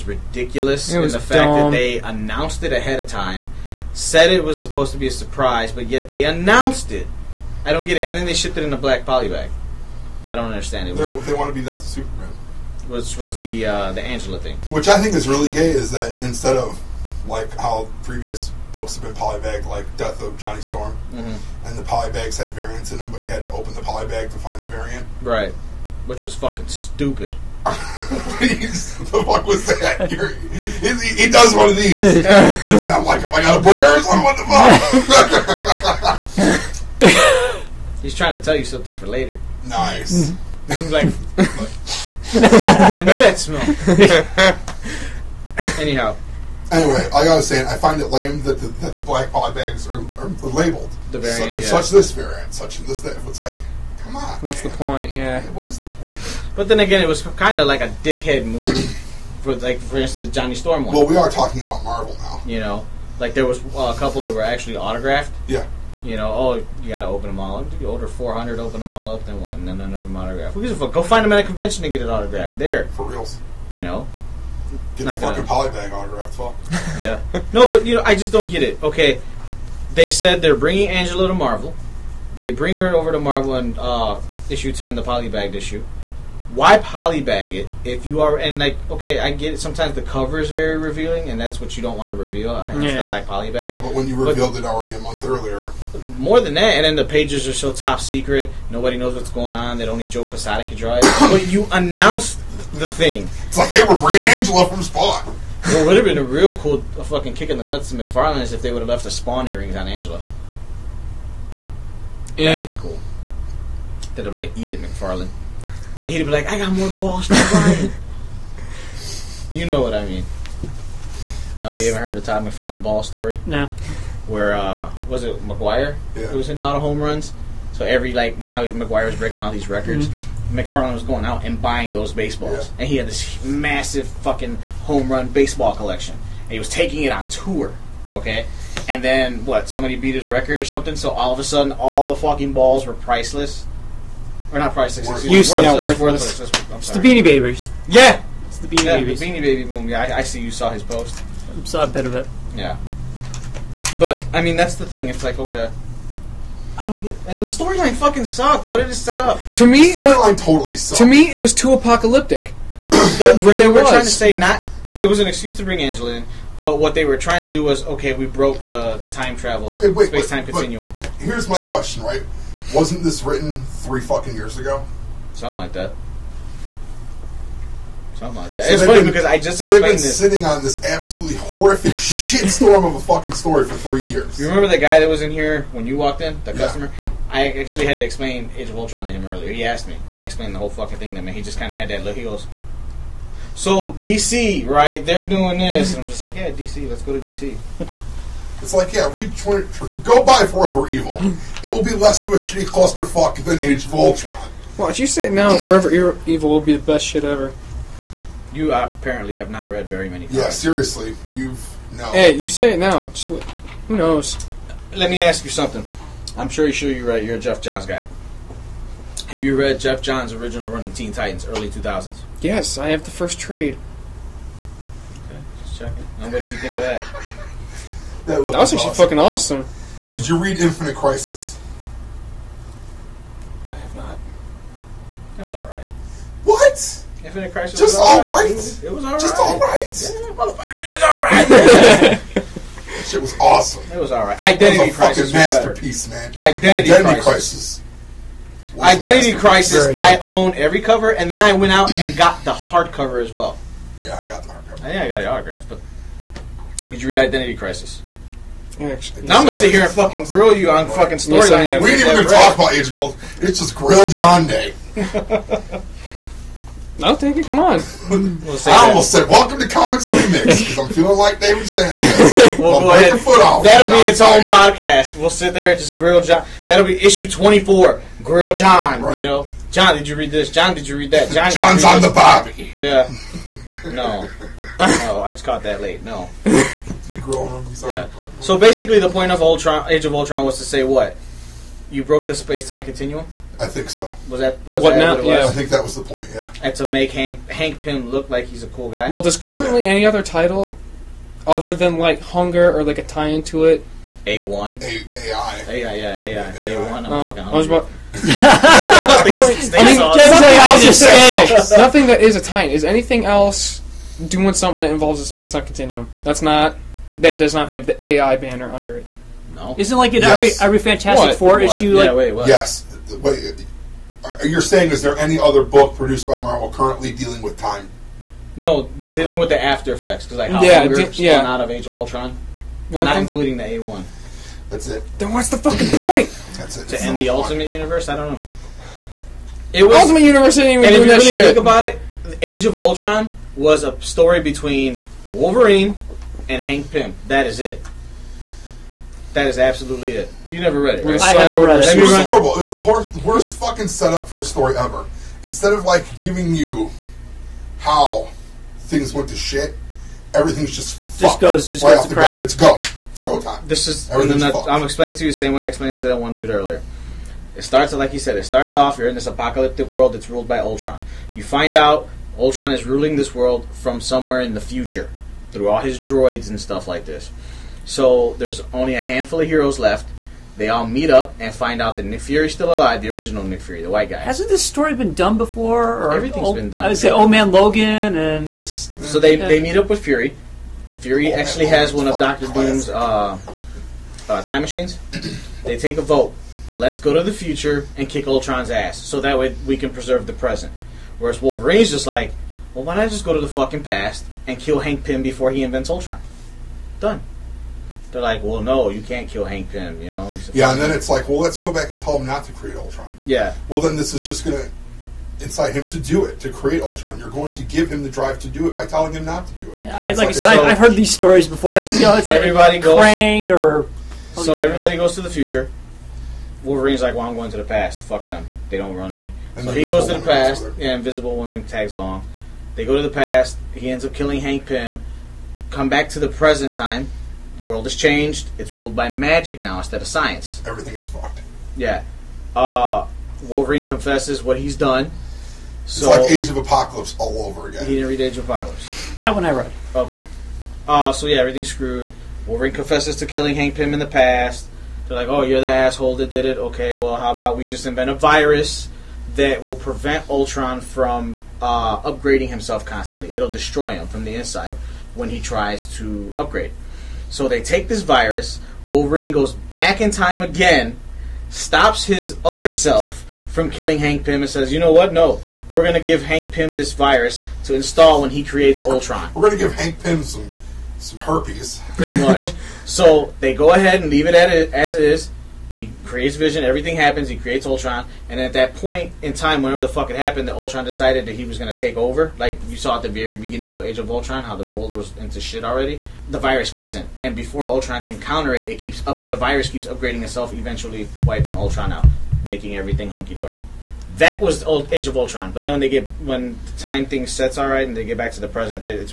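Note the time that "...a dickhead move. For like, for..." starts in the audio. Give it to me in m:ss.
0:57.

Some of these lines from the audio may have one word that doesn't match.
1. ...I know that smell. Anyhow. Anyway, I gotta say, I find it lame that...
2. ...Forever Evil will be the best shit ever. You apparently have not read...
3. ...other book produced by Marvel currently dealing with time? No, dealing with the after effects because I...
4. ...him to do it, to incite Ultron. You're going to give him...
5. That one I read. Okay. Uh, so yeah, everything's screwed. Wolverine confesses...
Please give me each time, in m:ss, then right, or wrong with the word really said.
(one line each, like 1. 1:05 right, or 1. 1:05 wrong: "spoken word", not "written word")
1. 0:42 right
2. 3:25 right
3. 5:25 right
4. 6:55 wrong: "create", not "incite"
5. 7:29 right.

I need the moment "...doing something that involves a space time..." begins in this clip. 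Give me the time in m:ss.
5:14.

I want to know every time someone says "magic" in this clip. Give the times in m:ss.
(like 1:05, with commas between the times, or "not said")
7:19.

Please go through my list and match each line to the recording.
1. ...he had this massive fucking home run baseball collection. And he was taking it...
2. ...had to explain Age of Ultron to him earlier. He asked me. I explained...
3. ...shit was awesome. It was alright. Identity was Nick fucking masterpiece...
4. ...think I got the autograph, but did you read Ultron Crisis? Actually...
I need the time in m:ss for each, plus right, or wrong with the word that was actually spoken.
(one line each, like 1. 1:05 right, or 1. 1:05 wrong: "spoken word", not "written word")
1. 2:12 right
2. 3:07 right
3. 4:03 wrong: "Crisis", not "Nick"
4. 4:14 wrong: "Identity", not "Ultron".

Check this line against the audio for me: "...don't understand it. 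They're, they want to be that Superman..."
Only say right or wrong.
right.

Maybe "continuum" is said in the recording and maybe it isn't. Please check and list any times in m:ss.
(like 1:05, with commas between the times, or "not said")
2:50, 4:52, 5:15.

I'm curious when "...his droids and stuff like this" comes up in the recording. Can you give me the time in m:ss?
6:15.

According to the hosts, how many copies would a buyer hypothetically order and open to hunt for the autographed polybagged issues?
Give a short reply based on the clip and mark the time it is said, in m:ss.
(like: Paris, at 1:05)
400, at 1:08.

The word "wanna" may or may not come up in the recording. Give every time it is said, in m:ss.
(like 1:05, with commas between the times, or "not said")
not said.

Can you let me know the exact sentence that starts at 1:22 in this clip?
They bring her over to Marvel and uh, issue ten, the polybagged issue.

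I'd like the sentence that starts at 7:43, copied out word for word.
It'll destroy him from the inside when he tries to upgrade.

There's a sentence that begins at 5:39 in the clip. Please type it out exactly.
It was Ultimate Universe didn't even and do if you really shit.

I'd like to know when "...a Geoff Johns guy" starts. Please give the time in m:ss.
3:37.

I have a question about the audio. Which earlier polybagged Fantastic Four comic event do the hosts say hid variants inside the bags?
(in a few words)
Death of Johnny Storm.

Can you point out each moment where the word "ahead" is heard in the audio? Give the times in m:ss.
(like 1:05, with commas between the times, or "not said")
0:02, 8:03.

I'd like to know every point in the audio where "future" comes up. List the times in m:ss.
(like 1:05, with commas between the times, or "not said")
6:14, 6:37, 7:05.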